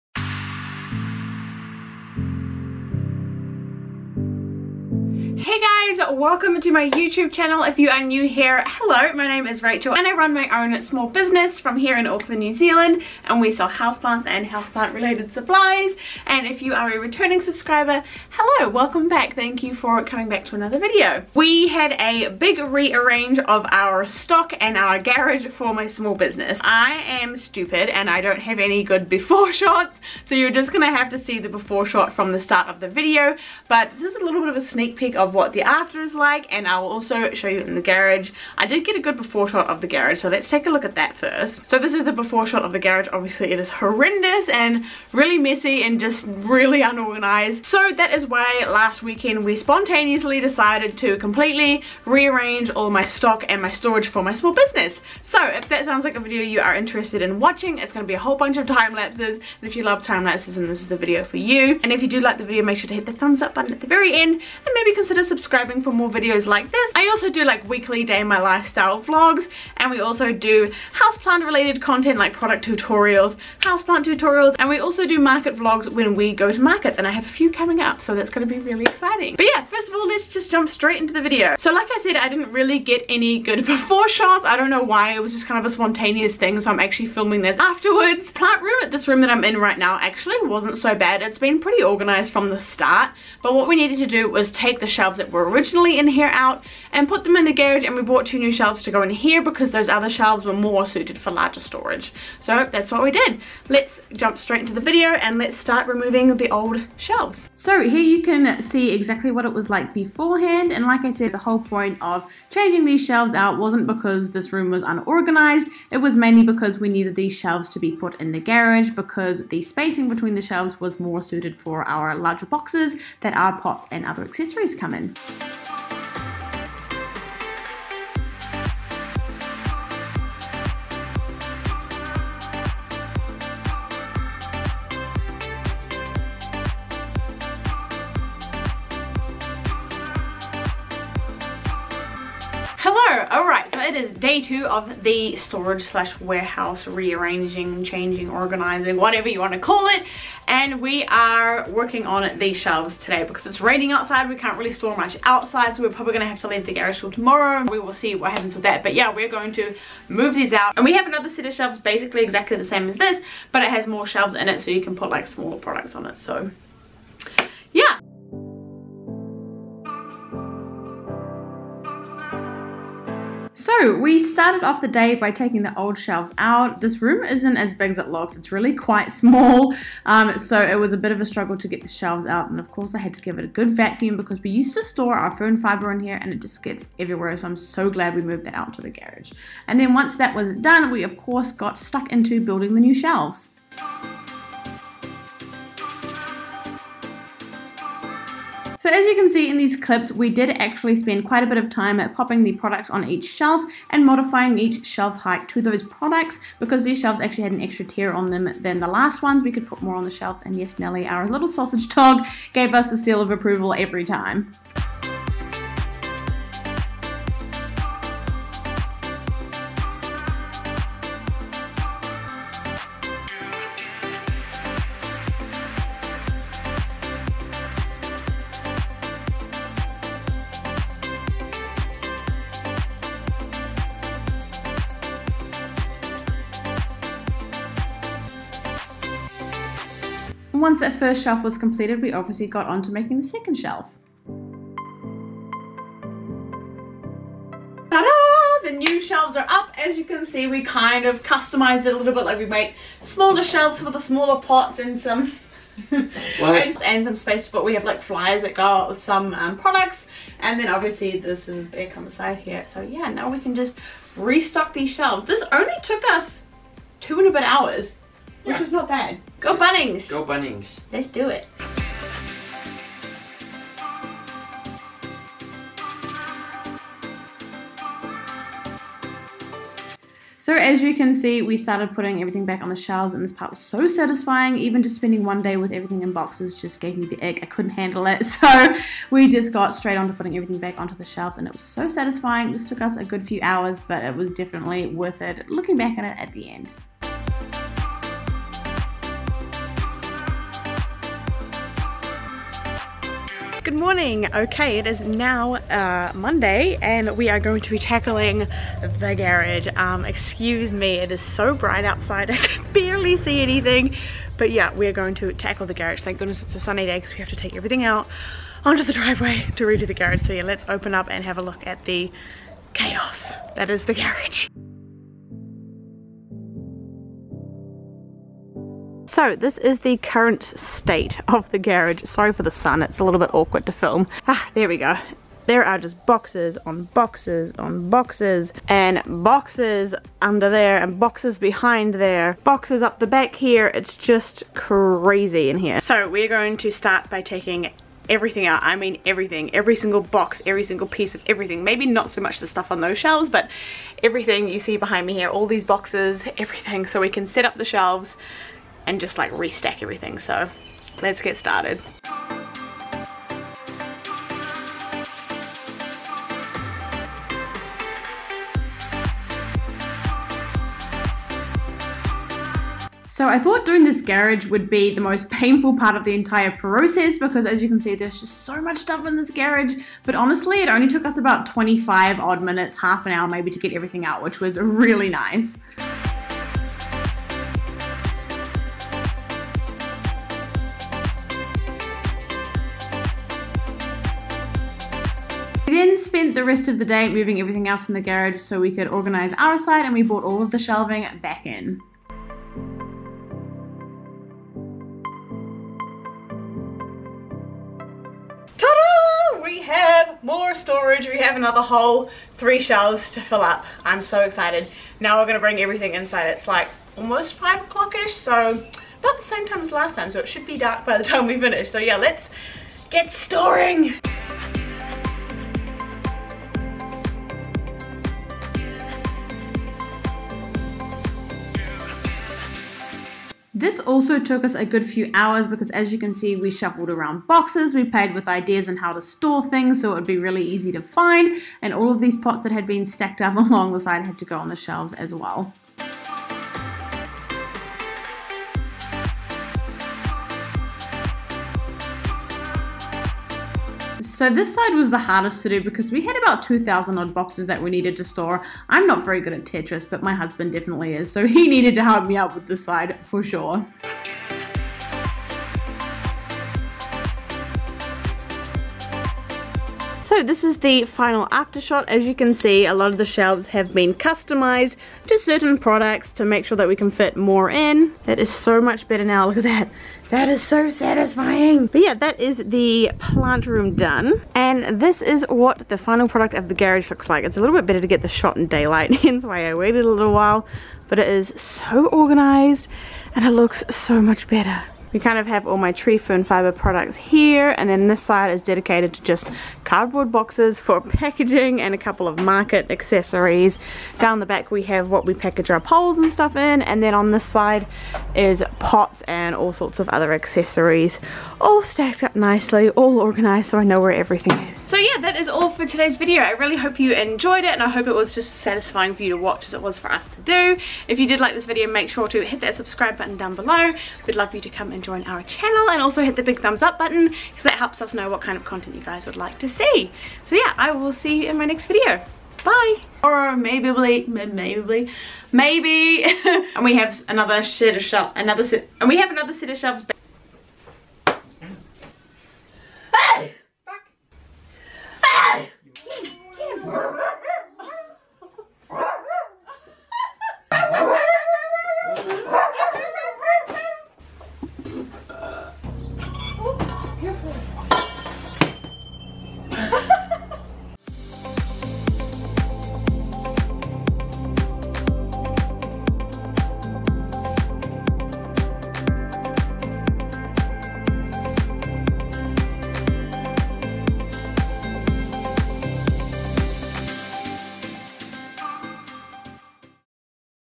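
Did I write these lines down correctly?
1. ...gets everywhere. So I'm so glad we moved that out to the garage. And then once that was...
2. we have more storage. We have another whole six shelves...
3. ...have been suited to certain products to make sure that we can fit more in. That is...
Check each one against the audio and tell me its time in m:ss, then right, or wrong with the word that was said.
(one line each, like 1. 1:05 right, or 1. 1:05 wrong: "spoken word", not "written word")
1. 3:06 right
2. 6:49 wrong: "three", not "six"
3. 7:53 wrong: "customized", not "suited".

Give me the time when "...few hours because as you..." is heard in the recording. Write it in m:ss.
7:14.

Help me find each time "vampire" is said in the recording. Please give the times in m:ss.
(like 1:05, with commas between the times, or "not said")
not said.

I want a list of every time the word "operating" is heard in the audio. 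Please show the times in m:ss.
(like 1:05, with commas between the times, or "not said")
not said.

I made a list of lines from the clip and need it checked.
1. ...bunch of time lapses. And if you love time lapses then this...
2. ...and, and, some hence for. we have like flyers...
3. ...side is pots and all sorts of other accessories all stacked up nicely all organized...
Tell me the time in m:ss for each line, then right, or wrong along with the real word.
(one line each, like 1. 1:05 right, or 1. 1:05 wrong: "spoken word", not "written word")
1. 0:58 right
2. 4:15 wrong: "space", not "hence"
3. 8:27 right.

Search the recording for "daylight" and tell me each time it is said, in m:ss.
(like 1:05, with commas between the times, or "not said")
8:08.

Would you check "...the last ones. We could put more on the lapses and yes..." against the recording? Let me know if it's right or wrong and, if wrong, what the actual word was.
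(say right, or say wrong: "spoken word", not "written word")
wrong: "shelves", not "lapses".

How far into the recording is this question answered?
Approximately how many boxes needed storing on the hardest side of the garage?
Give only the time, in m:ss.
7:36.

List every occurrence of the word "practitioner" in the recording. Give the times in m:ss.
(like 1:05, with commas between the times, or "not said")
not said.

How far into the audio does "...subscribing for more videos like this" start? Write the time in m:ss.
1:05.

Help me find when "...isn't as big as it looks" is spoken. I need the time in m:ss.
2:57.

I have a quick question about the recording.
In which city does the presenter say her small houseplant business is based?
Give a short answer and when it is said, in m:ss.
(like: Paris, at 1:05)
Auckland, at 0:12.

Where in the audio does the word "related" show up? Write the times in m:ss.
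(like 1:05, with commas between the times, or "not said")
0:14, 1:11.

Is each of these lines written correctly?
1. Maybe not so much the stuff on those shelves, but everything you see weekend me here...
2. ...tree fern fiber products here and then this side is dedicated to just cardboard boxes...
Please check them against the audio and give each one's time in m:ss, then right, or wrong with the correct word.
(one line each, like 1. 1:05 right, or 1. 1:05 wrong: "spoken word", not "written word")
1. 5:51 wrong: "behind", not "weekend"
2. 8:15 right.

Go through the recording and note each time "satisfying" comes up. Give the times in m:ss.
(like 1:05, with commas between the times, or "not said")
4:43, 4:51, 8:00, 8:38.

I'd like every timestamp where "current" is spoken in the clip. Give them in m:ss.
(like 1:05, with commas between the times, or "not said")
5:29.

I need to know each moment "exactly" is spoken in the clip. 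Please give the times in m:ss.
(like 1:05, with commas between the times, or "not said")
1:48, 2:42.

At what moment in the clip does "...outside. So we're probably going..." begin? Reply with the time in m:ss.
2:35.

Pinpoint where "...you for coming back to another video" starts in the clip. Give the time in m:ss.
0:19.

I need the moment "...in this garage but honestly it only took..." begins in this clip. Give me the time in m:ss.
6:19.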